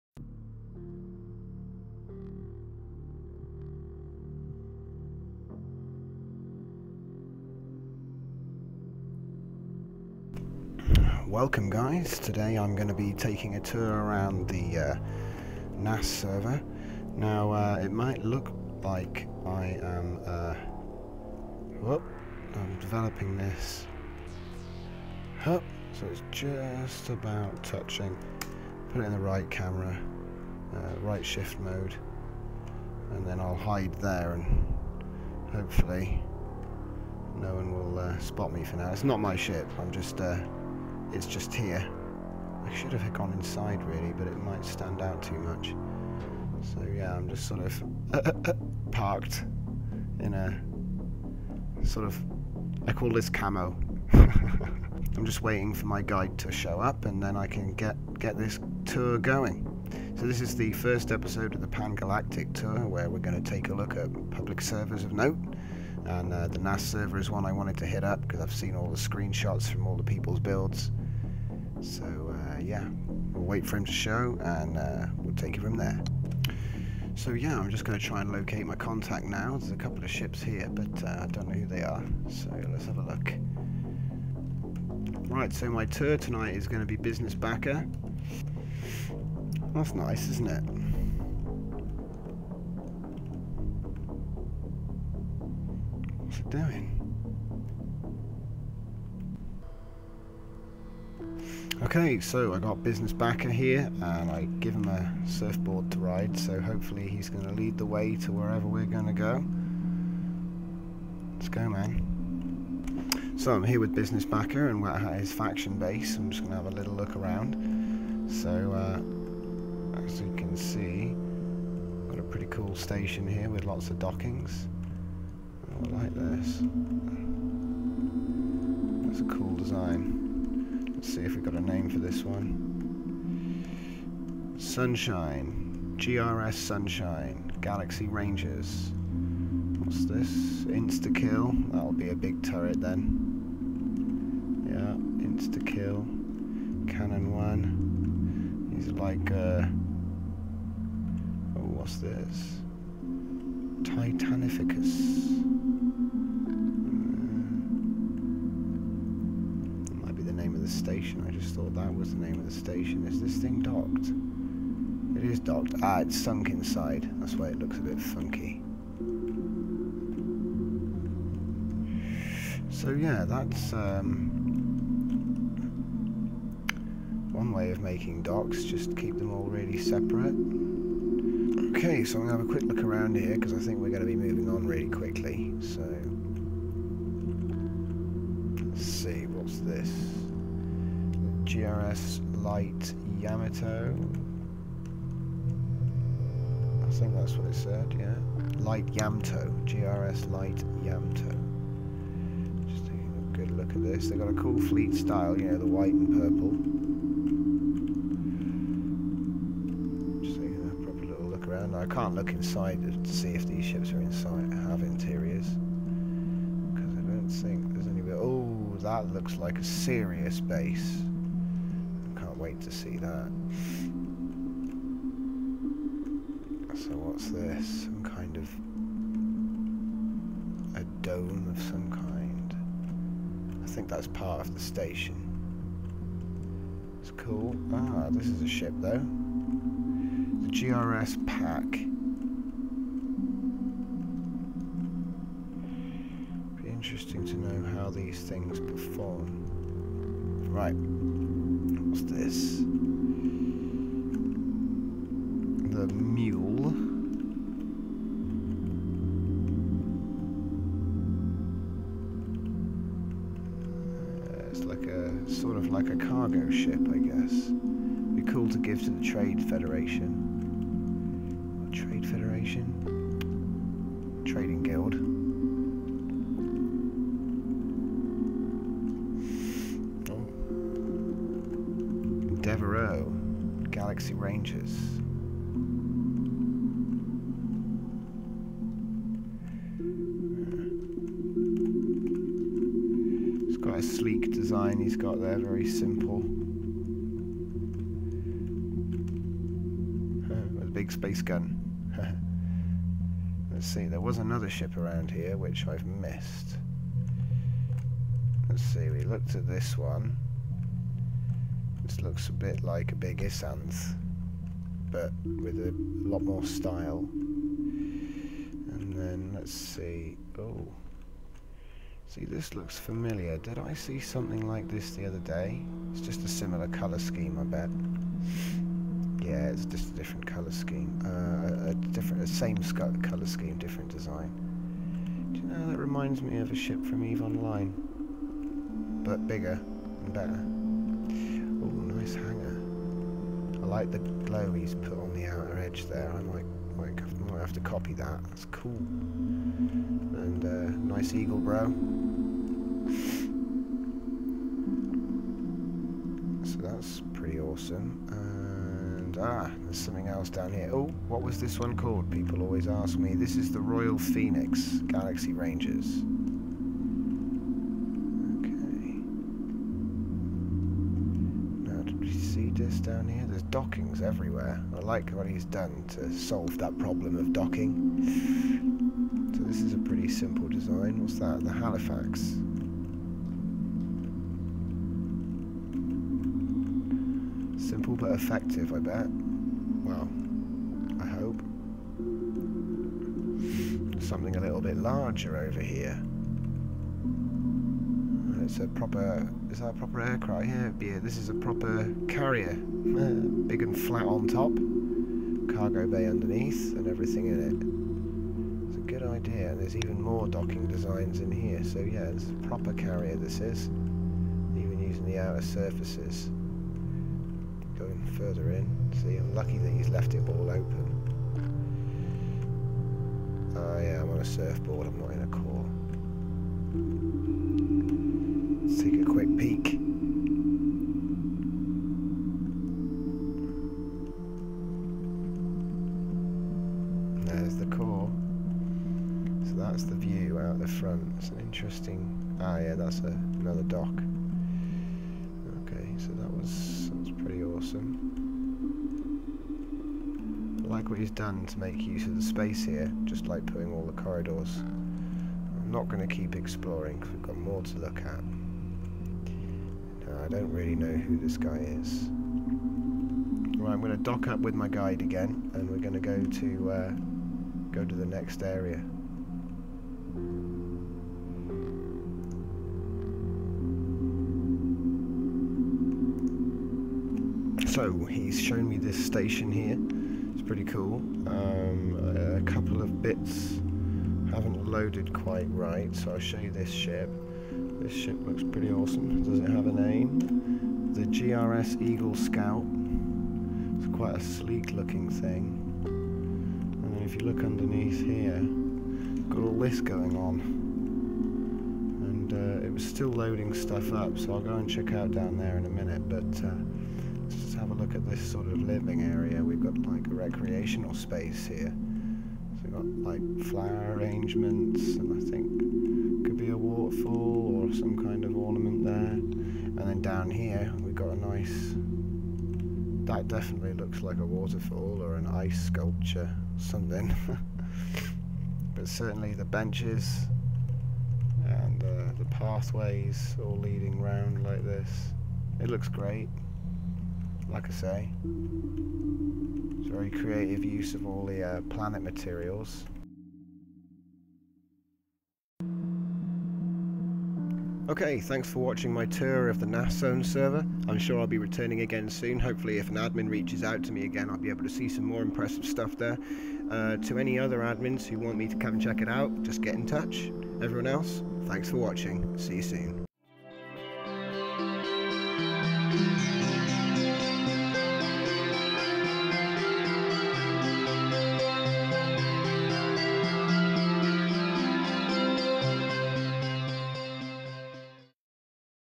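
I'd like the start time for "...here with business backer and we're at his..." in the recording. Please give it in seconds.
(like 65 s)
113 s.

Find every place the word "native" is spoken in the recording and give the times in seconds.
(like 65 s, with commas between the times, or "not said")
not said.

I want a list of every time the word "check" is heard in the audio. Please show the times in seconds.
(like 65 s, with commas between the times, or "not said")
504 s, 558 s.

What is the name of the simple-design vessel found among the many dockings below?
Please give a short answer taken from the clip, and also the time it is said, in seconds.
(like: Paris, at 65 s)
The Halifax, at 381 s.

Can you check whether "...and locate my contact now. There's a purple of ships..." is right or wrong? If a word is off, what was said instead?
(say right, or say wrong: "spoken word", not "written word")
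wrong: "couple", not "purple".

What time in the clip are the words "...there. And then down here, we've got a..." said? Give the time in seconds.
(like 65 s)
518 s.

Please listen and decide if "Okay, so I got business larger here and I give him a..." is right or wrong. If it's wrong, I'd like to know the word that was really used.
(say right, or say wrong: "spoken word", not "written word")
wrong: "backer", not "larger".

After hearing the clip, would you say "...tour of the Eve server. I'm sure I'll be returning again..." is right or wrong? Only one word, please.
wrong.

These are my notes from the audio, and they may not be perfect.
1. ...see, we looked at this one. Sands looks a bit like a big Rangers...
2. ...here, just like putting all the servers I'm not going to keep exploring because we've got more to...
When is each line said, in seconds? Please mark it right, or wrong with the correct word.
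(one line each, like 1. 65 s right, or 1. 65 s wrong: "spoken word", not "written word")
1. 308 s wrong: "Isanth", not "Rangers"
2. 452 s wrong: "corridors", not "servers".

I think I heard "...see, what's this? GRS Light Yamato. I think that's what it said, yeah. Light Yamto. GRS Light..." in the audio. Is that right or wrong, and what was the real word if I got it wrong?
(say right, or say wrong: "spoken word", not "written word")
right.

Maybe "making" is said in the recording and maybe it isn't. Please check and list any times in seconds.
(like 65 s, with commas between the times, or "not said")
177 s.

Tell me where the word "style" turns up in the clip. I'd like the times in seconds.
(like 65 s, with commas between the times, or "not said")
204 s, 316 s.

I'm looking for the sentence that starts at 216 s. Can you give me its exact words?
Because I don't think there's any...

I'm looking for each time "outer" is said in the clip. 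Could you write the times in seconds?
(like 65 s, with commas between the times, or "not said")
345 s, 415 s.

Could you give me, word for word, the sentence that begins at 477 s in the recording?
So he's shown me this station here.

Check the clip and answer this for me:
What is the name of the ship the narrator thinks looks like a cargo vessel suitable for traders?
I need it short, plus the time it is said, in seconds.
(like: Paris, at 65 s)
The Mule, at 255 s.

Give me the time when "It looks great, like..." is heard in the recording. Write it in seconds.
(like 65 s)
535 s.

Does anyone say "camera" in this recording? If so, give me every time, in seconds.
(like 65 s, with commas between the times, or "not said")
29 s.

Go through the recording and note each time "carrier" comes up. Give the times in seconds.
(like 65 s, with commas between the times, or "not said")
402 s, 412 s.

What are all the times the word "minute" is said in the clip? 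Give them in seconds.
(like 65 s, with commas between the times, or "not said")
505 s.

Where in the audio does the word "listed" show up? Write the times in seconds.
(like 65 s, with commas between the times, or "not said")
not said.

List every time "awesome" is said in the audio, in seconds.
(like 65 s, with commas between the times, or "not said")
357 s, 447 s, 488 s.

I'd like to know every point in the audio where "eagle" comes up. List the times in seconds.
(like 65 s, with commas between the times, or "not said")
351 s, 491 s.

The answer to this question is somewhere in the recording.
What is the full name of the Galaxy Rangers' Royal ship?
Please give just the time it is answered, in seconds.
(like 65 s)
363 s.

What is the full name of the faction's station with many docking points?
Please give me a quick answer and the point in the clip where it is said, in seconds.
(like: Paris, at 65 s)
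GRS Sunshine, at 135 s.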